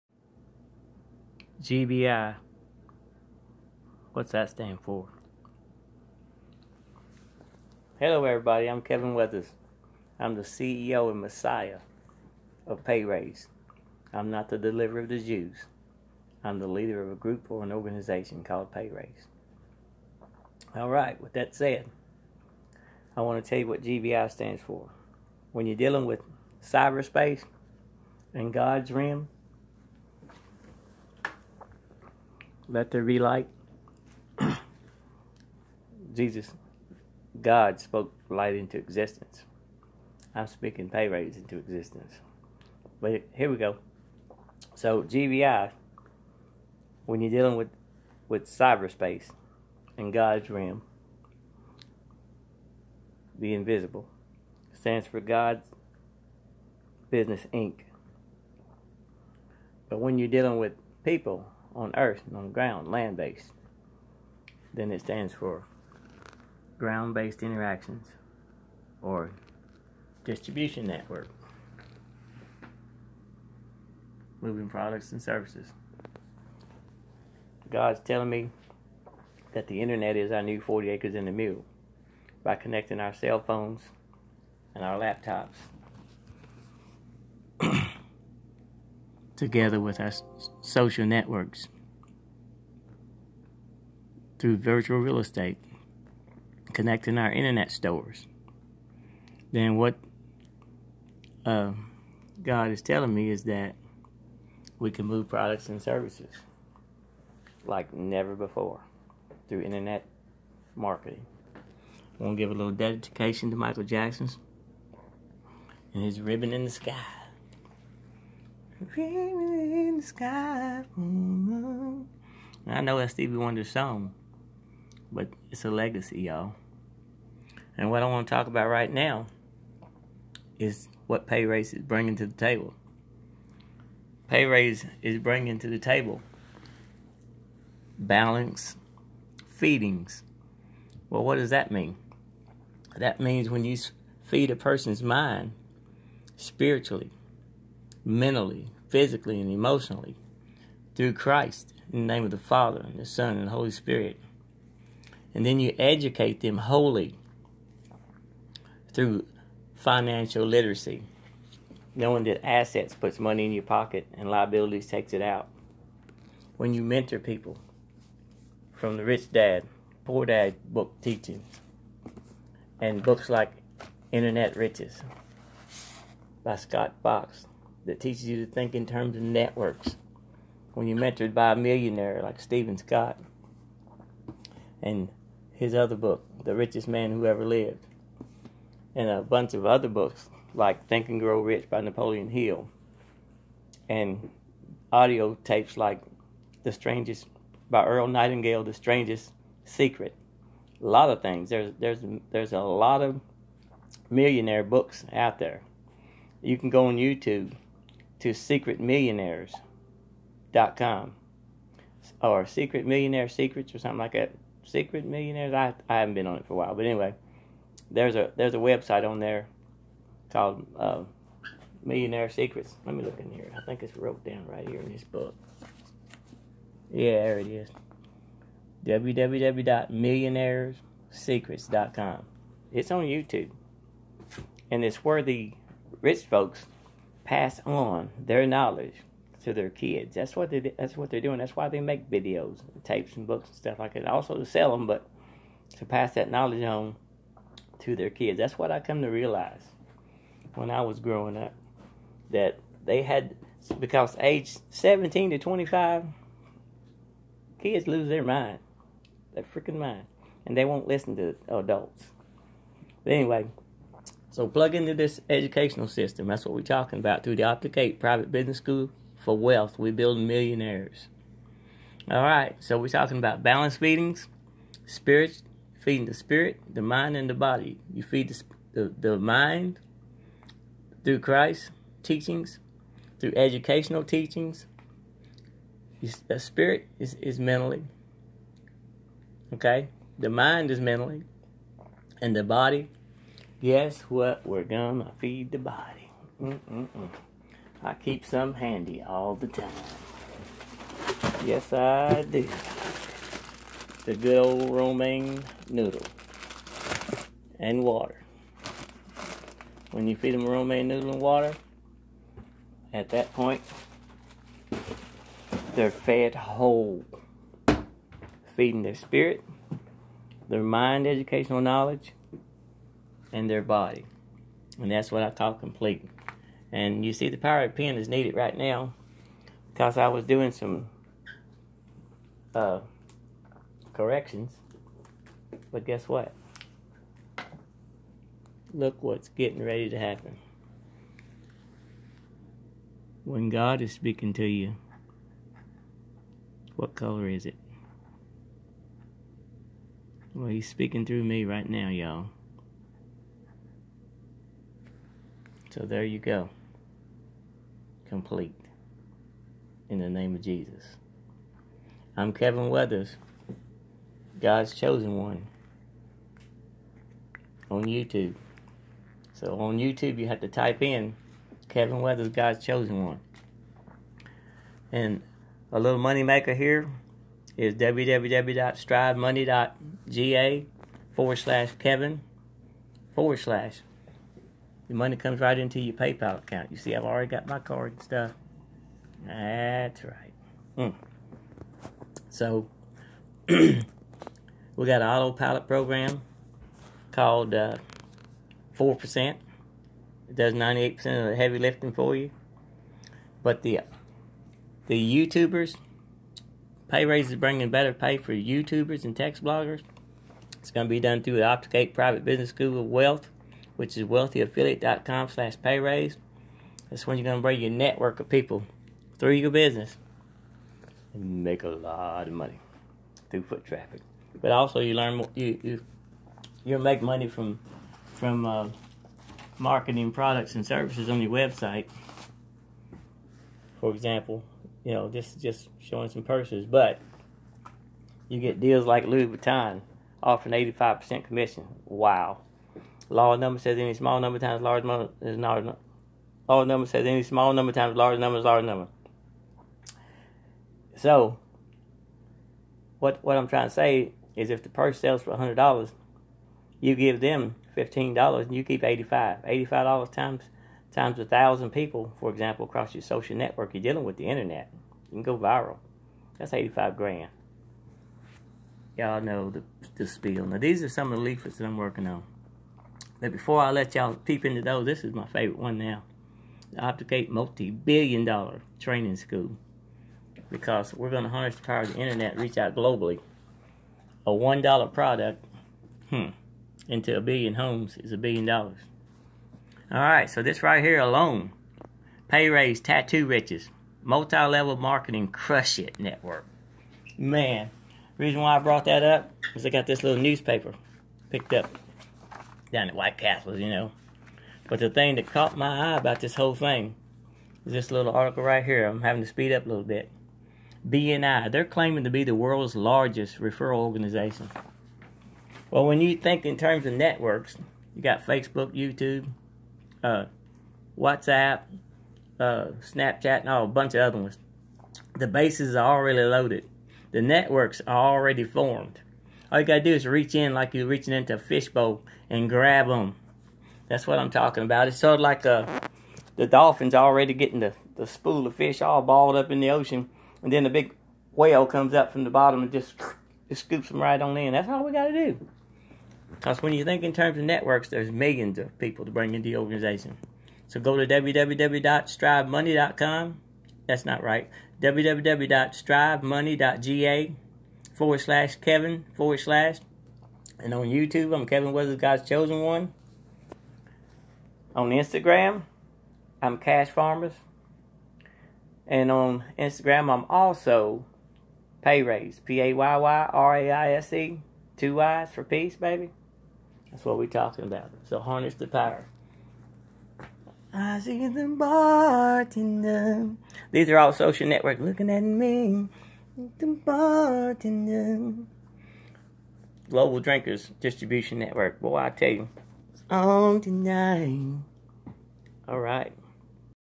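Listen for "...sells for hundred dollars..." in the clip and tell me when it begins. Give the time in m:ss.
7:34.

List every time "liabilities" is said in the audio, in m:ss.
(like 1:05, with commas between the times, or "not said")
2:44.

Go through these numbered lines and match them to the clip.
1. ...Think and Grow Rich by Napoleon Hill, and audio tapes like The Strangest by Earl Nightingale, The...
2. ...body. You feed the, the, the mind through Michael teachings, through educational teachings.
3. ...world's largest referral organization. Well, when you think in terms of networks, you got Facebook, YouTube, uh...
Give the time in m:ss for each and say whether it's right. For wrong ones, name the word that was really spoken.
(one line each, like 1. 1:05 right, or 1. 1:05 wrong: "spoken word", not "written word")
1. 3:10 right
2. 4:37 wrong: "Christ", not "Michael"
3. 8:32 right.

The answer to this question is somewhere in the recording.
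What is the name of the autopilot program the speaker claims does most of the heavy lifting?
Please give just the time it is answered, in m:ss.
6:38.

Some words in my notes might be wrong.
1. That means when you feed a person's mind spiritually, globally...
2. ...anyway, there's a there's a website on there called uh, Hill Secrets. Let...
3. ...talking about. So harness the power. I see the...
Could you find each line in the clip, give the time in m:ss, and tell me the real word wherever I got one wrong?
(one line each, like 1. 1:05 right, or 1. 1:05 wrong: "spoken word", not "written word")
1. 2:22 wrong: "mentally", not "globally"
2. 3:36 wrong: "Millionaire", not "Hill"
3. 9:37 right.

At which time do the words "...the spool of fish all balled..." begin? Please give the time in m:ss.
8:57.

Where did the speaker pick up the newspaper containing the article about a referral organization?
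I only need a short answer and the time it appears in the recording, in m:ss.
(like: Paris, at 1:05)
White Castle, at 8:22.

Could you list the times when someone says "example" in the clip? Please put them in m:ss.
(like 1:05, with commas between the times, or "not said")
7:13, 7:42.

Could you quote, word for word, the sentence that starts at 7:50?
Now, these are some of the leaflets that I'm working on.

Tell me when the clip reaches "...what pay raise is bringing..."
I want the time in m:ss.
2:11.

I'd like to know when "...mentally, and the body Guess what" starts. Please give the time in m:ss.
4:50.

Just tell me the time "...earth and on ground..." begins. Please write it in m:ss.
1:01.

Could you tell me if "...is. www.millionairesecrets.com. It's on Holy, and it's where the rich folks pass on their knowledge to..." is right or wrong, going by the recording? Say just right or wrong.
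wrong.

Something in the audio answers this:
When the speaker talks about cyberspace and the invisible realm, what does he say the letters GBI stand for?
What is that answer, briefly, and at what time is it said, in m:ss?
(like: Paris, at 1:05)
God's Business Inc., at 0:55.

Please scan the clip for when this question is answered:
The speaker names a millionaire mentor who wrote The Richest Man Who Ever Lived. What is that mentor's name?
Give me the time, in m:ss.
3:02.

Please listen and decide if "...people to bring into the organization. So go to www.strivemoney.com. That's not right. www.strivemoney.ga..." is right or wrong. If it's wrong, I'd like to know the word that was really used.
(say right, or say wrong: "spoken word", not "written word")
right.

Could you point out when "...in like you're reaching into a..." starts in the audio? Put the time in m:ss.
8:50.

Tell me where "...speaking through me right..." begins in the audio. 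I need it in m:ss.
5:50.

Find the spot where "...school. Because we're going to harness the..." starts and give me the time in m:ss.
7:59.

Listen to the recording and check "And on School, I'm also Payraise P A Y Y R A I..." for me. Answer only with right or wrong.
wrong.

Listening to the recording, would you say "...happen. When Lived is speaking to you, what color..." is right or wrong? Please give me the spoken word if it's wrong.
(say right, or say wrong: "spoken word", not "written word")
wrong: "God", not "Lived".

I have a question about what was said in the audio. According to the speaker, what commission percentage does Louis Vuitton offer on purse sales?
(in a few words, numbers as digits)
85%.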